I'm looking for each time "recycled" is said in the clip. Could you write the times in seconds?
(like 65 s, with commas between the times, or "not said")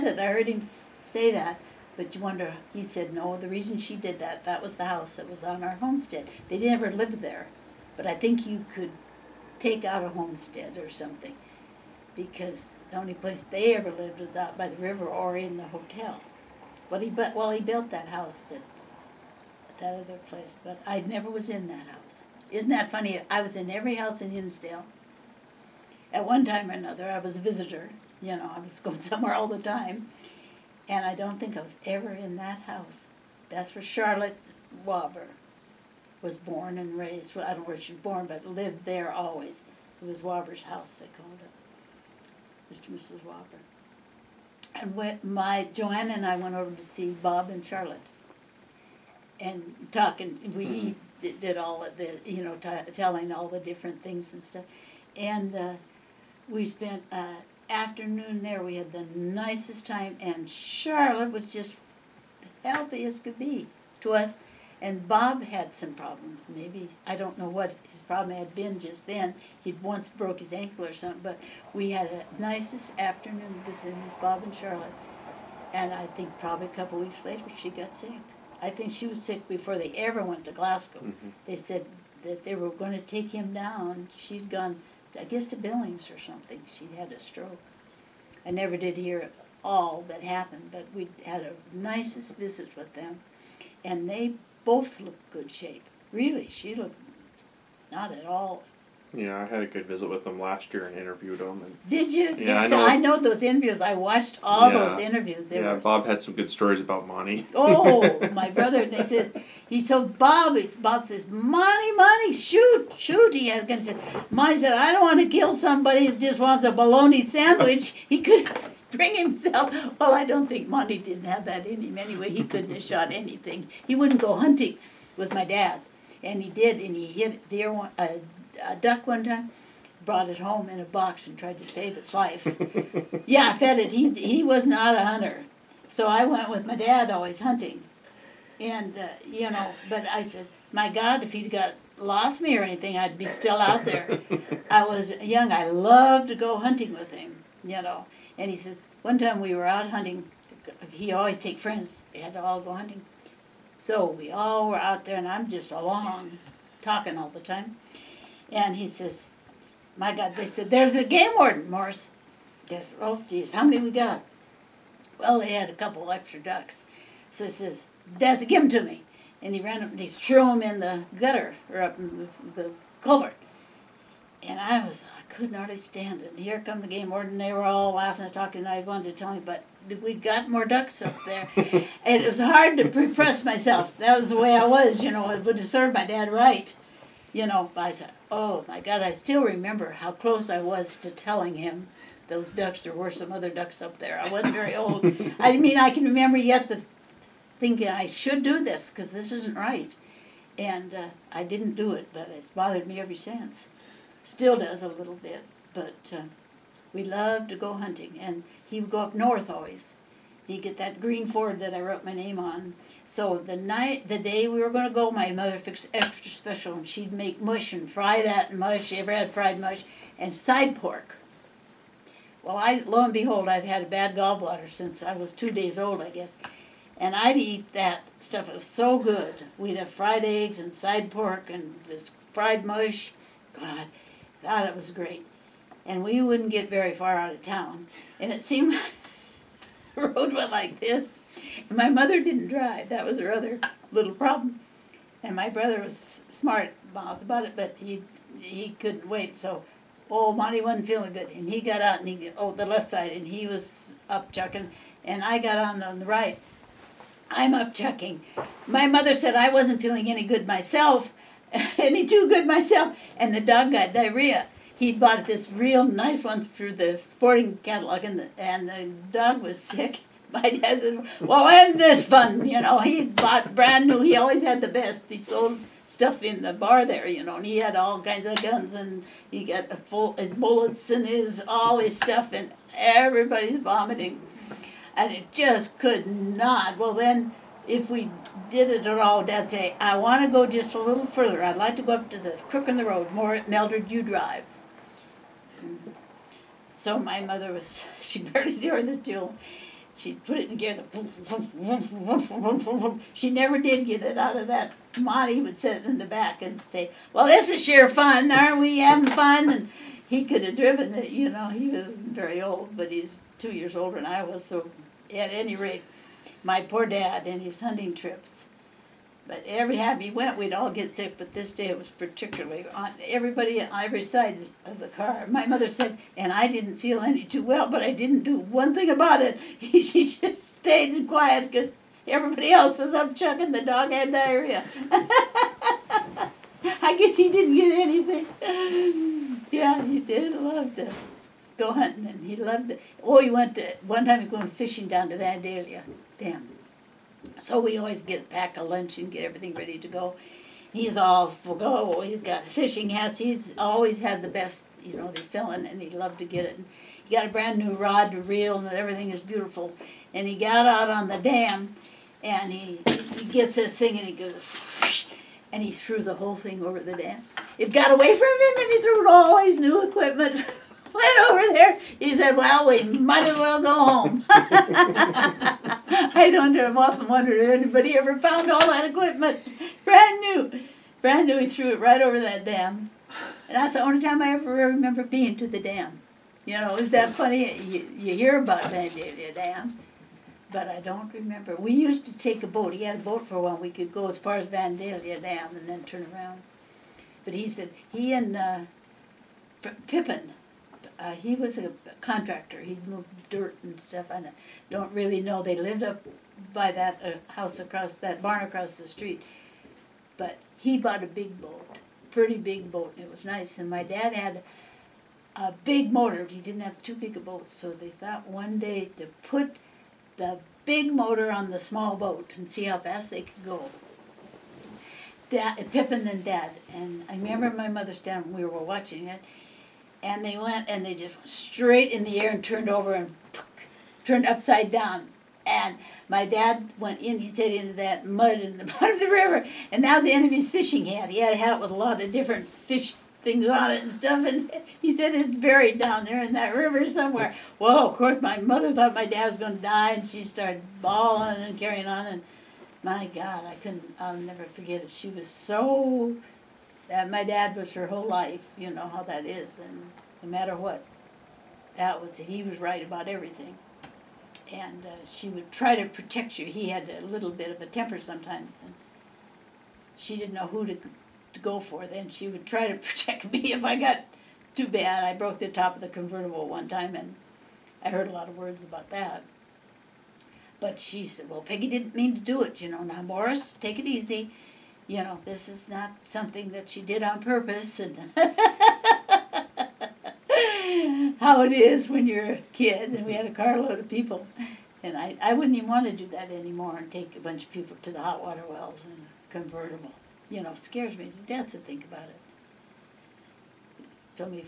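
not said.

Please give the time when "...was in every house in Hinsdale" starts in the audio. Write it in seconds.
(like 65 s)
23 s.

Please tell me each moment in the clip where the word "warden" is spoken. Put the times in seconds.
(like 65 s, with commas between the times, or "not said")
161 s, 177 s.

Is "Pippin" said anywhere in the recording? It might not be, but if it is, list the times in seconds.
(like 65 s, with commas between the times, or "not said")
399 s, 425 s.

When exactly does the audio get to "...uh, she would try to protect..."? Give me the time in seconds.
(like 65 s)
464 s.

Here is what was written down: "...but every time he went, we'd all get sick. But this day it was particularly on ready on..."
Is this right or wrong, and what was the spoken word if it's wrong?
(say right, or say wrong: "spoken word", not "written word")
wrong: "everybody", not "ready".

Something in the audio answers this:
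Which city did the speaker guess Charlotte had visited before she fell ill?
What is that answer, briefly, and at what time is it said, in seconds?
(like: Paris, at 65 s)
Billings, at 85 s.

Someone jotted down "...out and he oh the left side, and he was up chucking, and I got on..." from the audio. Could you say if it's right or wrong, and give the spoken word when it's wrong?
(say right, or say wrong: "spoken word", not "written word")
right.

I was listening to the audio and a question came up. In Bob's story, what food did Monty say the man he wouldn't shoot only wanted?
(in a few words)
A bologna sandwich.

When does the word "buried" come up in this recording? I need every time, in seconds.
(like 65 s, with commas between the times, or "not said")
298 s, 445 s.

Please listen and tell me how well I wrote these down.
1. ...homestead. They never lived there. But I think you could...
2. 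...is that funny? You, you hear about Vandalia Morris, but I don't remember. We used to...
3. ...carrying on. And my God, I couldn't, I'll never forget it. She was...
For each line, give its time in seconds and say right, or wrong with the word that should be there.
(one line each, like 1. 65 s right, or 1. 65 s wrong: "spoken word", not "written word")
1. 5 s right
2. 386 s wrong: "Dam", not "Morris"
3. 451 s right.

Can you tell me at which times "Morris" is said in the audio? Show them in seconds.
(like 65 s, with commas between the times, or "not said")
161 s, 483 s.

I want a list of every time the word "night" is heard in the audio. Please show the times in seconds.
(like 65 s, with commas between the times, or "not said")
213 s.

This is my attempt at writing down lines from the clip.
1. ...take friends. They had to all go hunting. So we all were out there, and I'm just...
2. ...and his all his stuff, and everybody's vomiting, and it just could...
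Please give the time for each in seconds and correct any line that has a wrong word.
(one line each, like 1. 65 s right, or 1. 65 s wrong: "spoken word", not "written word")
1. 151 s right
2. 280 s right.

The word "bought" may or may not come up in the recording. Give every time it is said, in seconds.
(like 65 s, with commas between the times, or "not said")
264 s, 273 s, 410 s.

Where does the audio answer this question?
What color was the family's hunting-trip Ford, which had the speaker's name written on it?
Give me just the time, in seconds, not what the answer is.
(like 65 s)
210 s.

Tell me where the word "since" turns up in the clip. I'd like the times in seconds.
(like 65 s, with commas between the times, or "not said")
203 s, 224 s.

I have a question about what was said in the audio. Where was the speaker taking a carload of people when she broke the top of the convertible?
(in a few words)
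The hot water wells.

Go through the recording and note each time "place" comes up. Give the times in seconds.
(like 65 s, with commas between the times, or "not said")
13 s, 20 s.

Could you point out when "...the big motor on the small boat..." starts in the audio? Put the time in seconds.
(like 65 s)
420 s.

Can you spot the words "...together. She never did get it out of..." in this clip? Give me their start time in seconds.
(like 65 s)
300 s.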